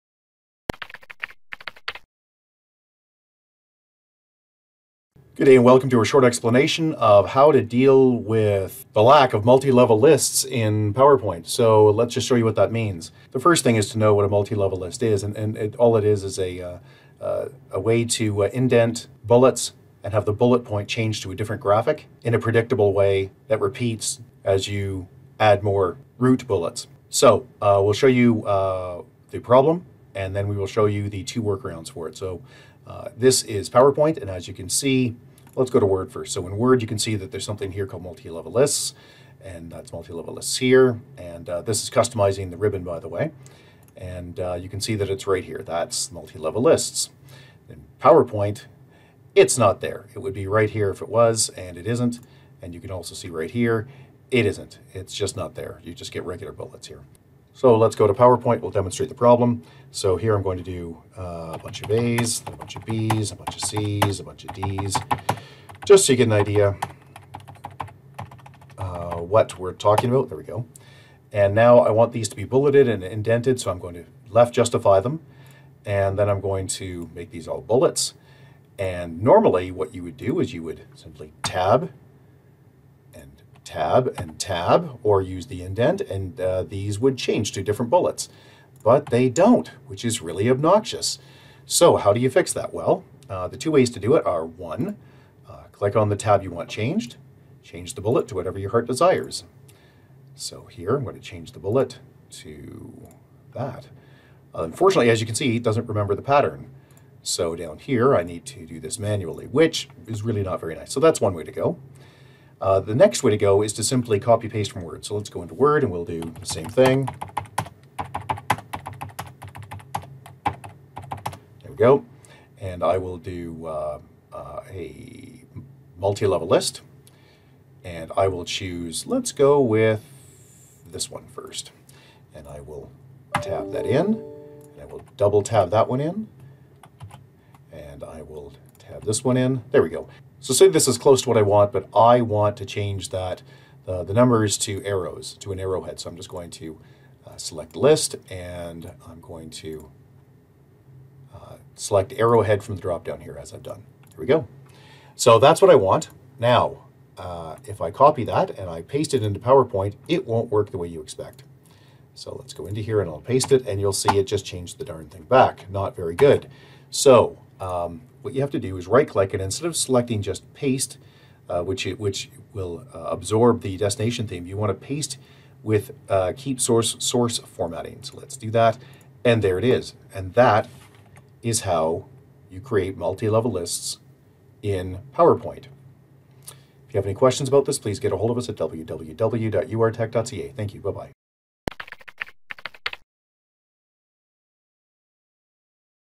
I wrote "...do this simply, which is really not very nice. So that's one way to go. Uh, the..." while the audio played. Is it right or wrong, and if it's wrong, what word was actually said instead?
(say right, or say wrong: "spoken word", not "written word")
wrong: "manually", not "simply".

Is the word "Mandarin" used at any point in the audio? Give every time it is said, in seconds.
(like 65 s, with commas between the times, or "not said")
not said.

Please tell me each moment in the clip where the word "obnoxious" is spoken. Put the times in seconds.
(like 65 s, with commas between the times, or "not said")
90 s.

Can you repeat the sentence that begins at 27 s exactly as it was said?
So uh, we'll show you uh, the problem and then we will show you the two workarounds for it.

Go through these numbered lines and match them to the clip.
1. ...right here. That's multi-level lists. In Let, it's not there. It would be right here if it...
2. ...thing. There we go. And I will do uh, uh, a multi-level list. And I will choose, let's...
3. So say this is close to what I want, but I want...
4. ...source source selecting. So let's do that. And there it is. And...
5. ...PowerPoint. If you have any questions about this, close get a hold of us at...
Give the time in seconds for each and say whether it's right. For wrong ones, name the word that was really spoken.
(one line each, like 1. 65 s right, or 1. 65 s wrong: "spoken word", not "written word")
1. 45 s wrong: "PowerPoint", not "Let"
2. 116 s right
3. 140 s right
4. 176 s wrong: "formatting", not "selecting"
5. 185 s wrong: "please", not "close".